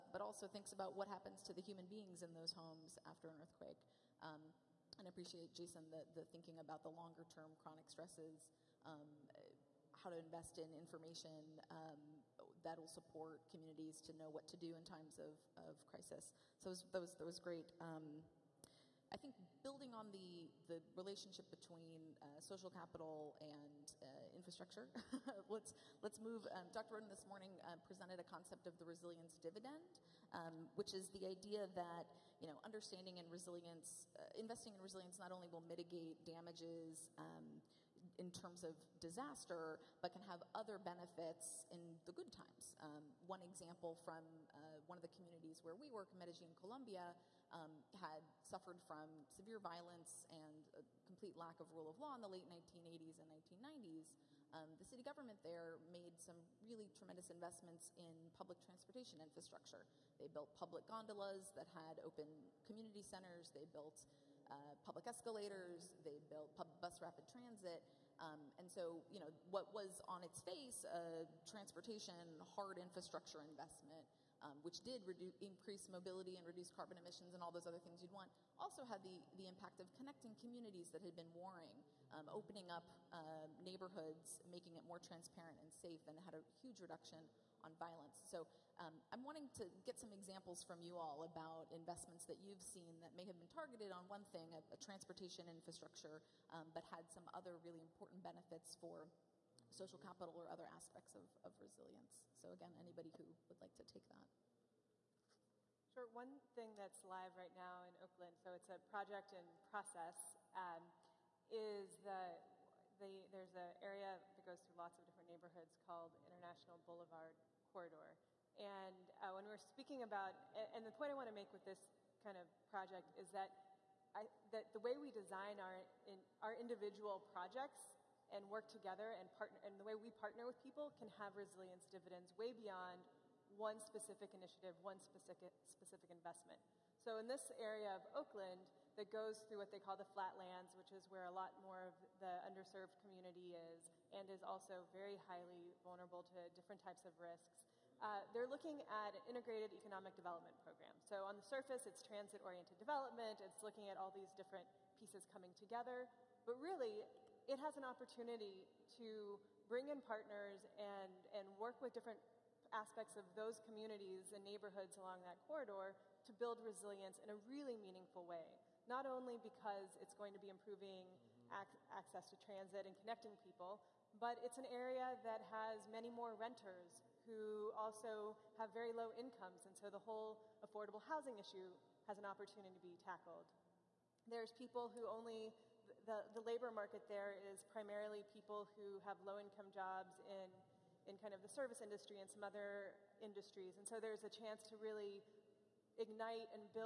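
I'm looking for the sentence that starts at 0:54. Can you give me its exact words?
Um, the city government there made some really tremendous investments in public transportation infrastructure.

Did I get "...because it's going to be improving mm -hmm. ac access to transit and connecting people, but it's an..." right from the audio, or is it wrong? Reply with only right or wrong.
right.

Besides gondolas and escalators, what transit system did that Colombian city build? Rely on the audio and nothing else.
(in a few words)
bus rapid transit.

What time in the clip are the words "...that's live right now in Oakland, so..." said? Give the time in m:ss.
1:46.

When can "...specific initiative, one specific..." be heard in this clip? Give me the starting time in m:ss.
2:13.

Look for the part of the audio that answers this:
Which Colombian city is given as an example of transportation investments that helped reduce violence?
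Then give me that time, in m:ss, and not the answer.
0:46.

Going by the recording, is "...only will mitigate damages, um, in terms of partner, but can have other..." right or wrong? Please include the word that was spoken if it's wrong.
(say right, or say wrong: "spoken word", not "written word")
wrong: "disaster", not "partner".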